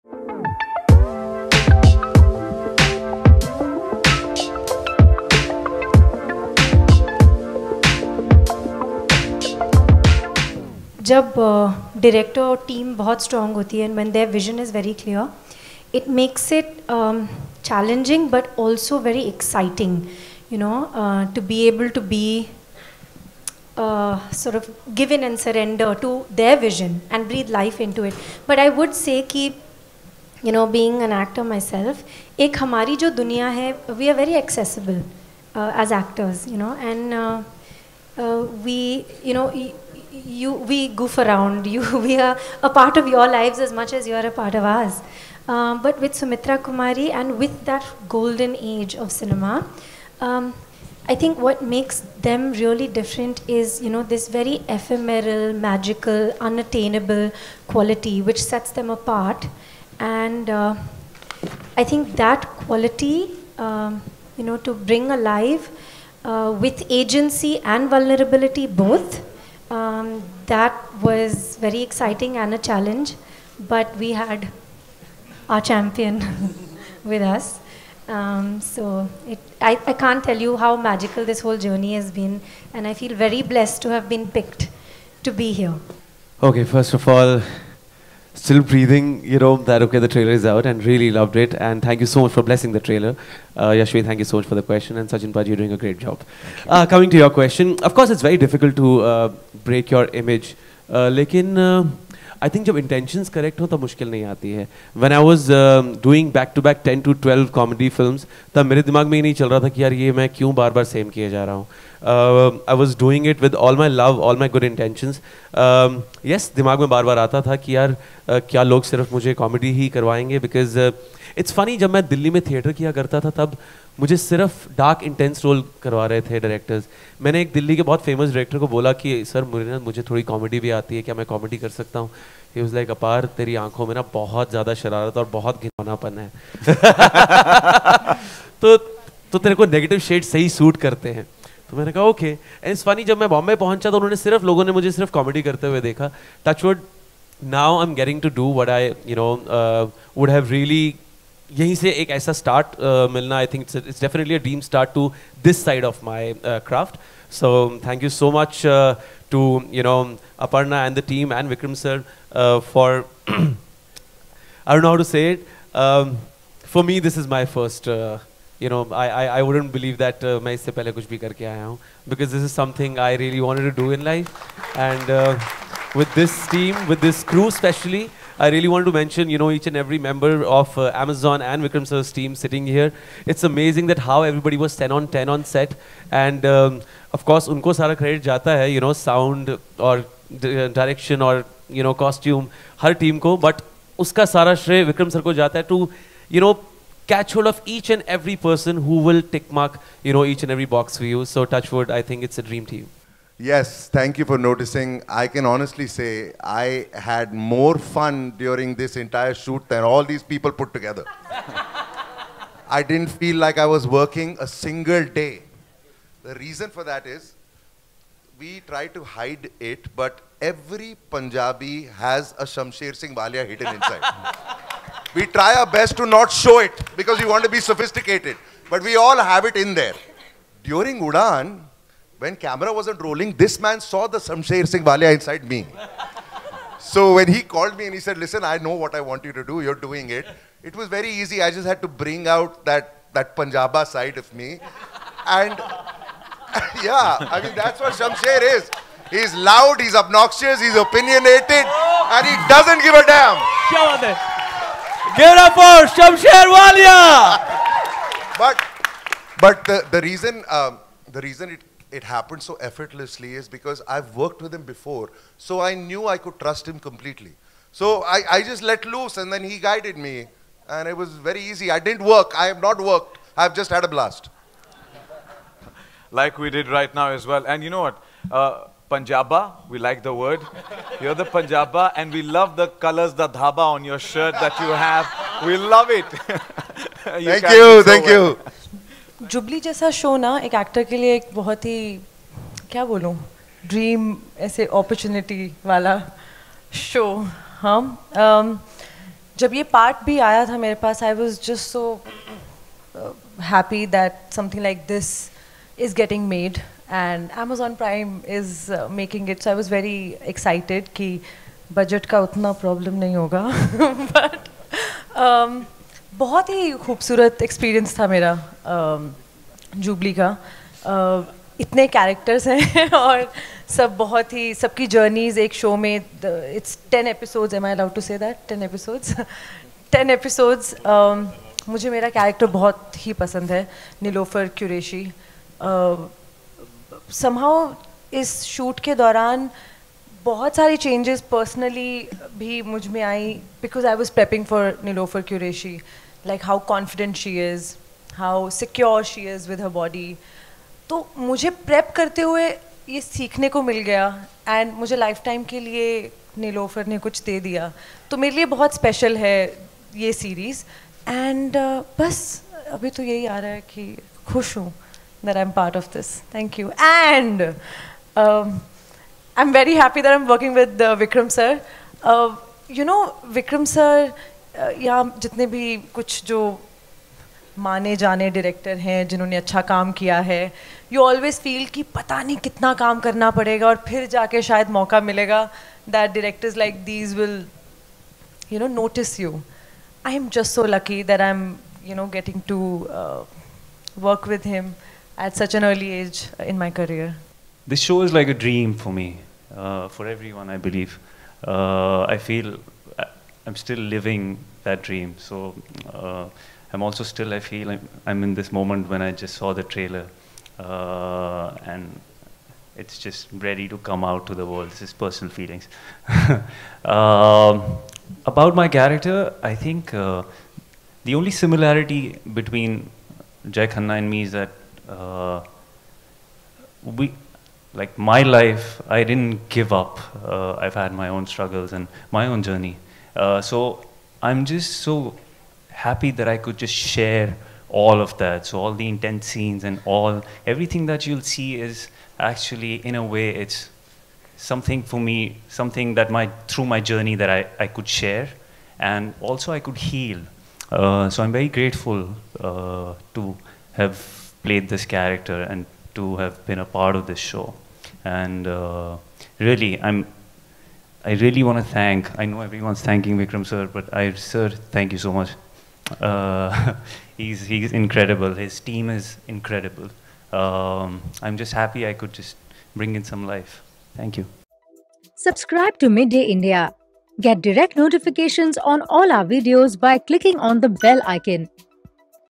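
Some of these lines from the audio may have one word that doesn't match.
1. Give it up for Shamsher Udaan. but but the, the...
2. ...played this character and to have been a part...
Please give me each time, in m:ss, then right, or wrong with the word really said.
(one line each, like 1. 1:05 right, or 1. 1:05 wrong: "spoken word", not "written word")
1. 4:13 wrong: "Walia", not "Udaan"
2. 7:34 right.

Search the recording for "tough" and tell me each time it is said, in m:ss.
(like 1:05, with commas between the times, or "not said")
not said.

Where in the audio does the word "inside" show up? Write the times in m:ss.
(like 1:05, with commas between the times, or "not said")
3:43, 3:55.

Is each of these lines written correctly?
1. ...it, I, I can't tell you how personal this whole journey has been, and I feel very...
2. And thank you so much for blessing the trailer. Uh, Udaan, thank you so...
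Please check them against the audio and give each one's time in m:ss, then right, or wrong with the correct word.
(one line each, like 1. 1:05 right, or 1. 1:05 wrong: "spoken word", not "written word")
1. 1:19 wrong: "magical", not "personal"
2. 1:31 wrong: "Yashvi", not "Udaan".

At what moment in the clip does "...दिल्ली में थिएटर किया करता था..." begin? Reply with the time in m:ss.
2:02.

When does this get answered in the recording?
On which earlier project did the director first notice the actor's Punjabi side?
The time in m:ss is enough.
3:51.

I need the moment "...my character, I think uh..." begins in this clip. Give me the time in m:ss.
6:58.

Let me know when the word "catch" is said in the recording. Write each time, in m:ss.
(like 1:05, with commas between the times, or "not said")
3:17.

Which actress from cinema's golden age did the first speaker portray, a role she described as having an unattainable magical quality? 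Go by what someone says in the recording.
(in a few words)
Sumitra Kumari.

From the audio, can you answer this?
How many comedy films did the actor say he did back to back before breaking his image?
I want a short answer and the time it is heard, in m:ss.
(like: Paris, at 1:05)
10 to 12, at 1:46.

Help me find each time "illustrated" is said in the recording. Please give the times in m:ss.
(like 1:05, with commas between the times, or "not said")
not said.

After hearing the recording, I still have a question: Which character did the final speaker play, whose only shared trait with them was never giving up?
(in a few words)
Jai Khanna.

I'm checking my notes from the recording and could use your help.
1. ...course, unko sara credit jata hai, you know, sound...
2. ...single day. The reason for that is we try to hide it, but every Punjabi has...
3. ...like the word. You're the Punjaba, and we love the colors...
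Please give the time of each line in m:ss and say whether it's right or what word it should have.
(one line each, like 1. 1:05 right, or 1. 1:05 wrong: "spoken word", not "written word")
1. 3:07 right
2. 3:34 right
3. 4:39 right.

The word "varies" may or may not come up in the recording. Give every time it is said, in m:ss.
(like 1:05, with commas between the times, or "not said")
not said.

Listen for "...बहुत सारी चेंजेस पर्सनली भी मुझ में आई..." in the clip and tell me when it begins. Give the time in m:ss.
5:40.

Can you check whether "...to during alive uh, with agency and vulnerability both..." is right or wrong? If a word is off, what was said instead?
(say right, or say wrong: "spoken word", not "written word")
wrong: "bring", not "during".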